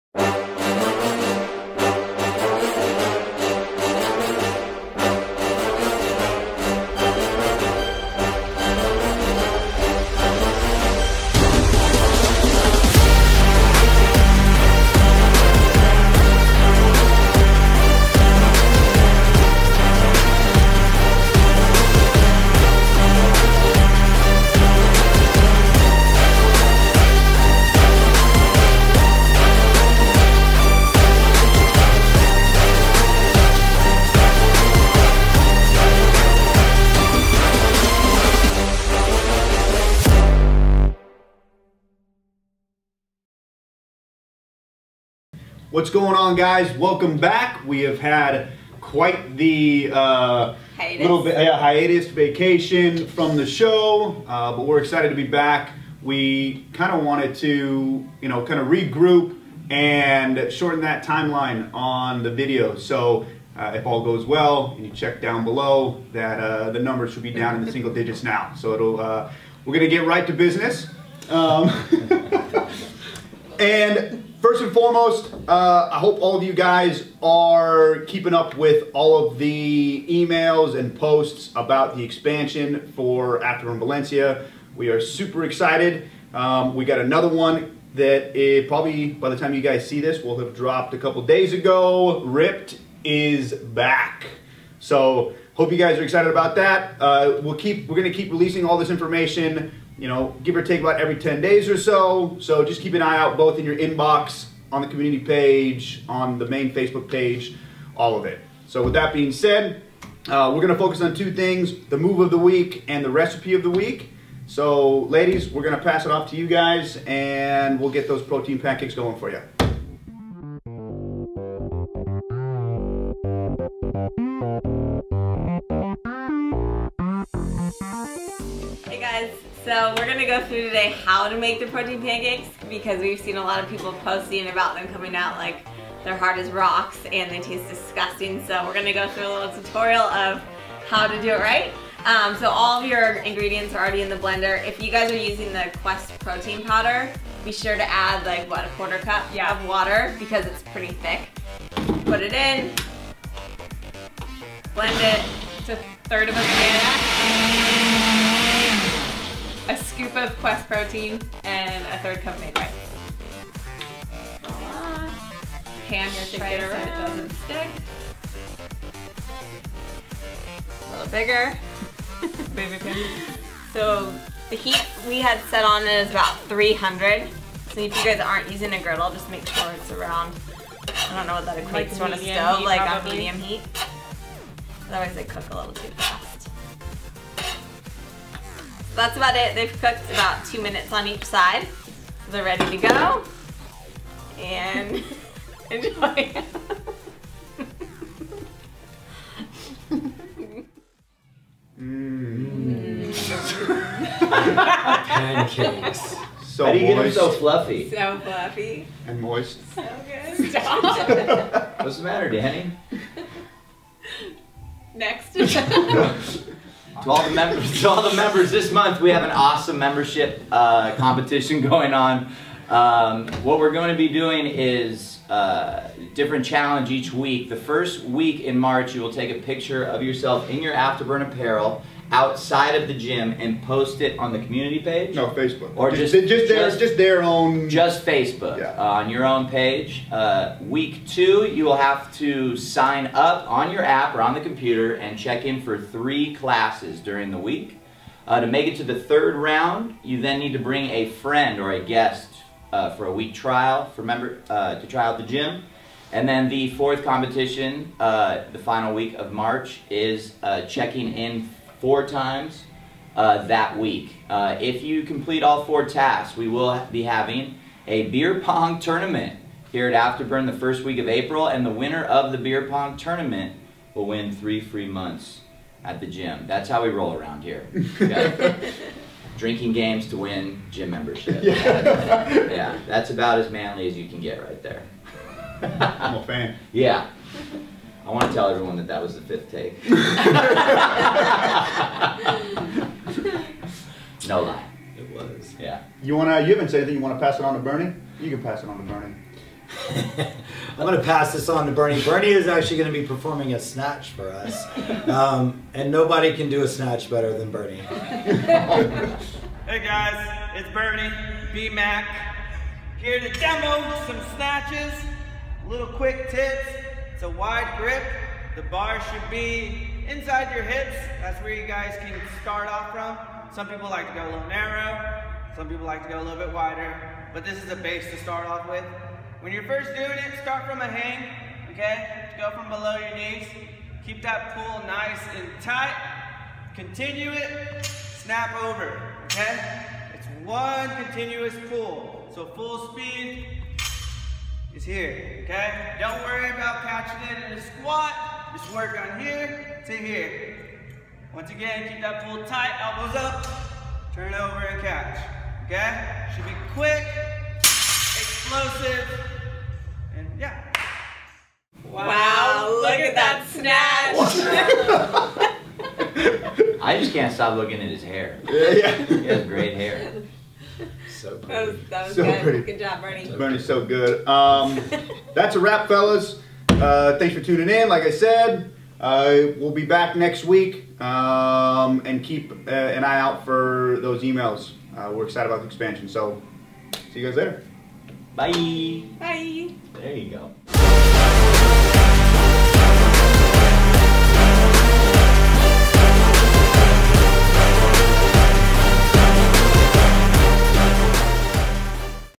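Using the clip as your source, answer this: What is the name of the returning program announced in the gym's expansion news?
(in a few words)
Ripped.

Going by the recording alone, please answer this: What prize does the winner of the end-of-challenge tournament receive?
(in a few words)
3 free months.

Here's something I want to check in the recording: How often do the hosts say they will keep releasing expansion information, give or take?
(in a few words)
every 10 days.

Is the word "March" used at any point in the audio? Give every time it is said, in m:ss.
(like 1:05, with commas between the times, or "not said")
3:48, 4:19.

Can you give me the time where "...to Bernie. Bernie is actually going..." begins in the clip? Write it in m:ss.
5:01.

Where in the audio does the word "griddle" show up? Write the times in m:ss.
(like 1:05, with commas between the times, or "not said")
2:58.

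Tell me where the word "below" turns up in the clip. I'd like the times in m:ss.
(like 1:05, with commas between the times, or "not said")
1:05, 5:32.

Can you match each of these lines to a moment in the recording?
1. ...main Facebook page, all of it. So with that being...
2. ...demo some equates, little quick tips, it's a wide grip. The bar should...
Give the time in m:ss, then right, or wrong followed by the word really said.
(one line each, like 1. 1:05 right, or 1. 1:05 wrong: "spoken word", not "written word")
1. 1:46 right
2. 5:13 wrong: "snatches", not "equates".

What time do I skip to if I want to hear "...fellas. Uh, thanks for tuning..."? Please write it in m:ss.
6:15.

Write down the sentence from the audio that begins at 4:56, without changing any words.
You wanna pass it on to Bernie?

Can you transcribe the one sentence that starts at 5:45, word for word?
Don't worry about catching it in a squat.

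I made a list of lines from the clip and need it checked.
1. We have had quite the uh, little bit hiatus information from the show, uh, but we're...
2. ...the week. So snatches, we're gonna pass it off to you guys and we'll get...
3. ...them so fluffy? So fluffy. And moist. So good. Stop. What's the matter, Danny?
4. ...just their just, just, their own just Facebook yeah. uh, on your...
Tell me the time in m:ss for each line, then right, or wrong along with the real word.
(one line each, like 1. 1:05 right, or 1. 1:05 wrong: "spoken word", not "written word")
1. 0:47 wrong: "vacation", not "information"
2. 1:53 wrong: "ladies", not "snatches"
3. 3:27 right
4. 3:56 right.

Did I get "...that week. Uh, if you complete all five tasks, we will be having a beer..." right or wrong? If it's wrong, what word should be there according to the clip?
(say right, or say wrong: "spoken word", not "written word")
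wrong: "four", not "five".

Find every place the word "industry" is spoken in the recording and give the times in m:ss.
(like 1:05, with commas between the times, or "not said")
not said.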